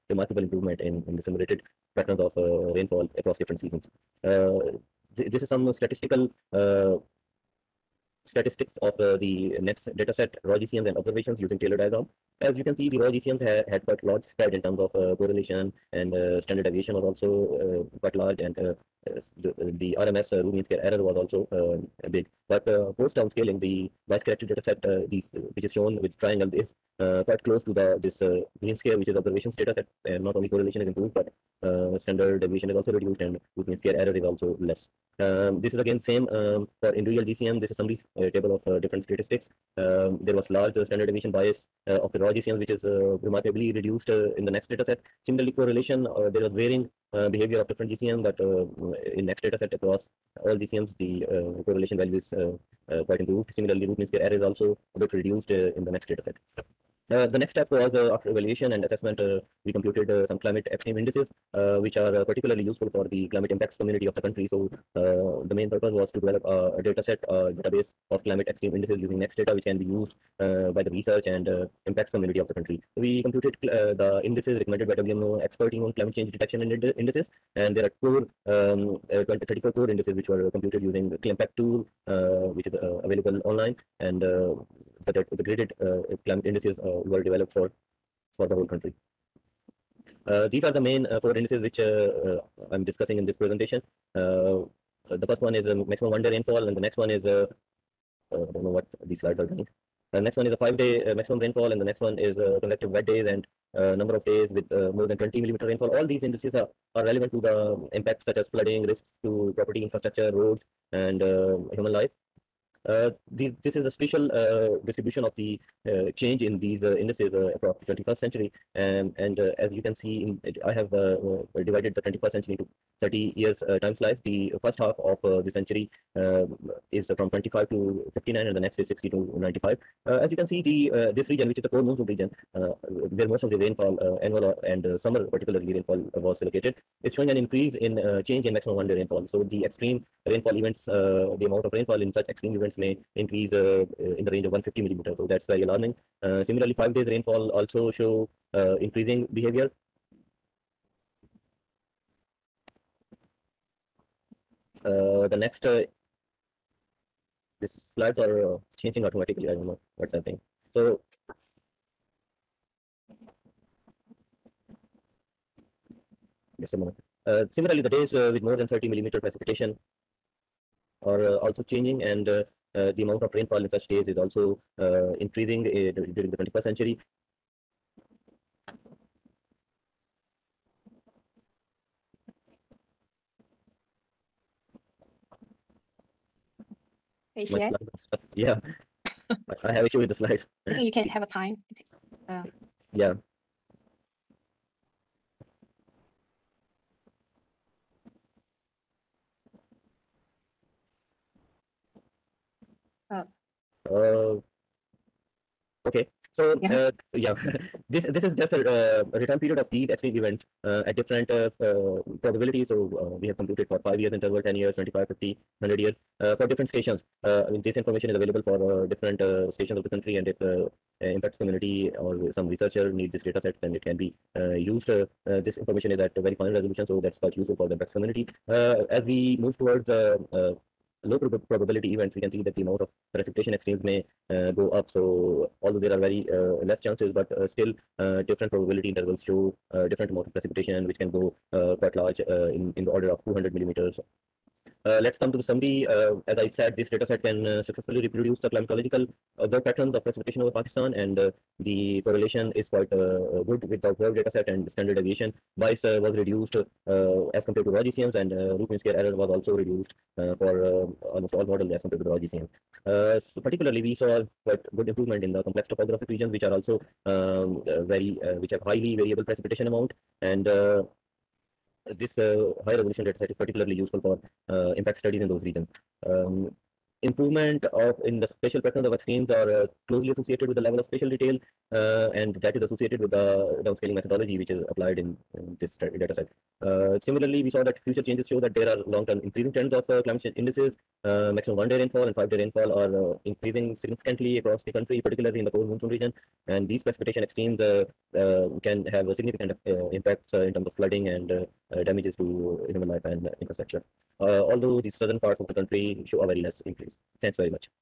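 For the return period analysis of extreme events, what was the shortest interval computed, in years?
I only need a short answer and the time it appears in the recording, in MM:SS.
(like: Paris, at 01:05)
5 years, at 03:33.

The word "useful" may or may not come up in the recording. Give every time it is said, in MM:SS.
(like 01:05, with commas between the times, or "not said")
01:02, 03:47, 04:33.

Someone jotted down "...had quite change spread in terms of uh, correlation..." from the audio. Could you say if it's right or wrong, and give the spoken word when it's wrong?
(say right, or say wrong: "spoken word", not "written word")
wrong: "large", not "change".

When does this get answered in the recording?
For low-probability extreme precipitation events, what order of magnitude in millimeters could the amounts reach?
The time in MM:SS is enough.
04:03.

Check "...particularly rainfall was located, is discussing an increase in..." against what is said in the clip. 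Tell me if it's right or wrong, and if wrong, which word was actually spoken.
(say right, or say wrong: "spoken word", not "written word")
wrong: "showing", not "discussing".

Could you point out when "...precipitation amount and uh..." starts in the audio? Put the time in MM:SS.
04:29.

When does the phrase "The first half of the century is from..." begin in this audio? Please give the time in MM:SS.
02:04.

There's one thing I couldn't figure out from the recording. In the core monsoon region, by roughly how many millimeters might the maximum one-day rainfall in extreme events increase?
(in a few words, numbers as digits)
150 millimeters.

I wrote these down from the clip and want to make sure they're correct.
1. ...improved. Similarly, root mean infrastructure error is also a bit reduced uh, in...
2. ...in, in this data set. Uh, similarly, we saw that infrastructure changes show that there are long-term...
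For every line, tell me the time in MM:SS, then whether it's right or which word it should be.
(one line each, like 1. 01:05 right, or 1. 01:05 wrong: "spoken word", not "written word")
1. 00:53 wrong: "square", not "infrastructure"
2. 04:44 wrong: "future", not "infrastructure".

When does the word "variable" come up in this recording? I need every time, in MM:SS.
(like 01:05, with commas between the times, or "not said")
04:28.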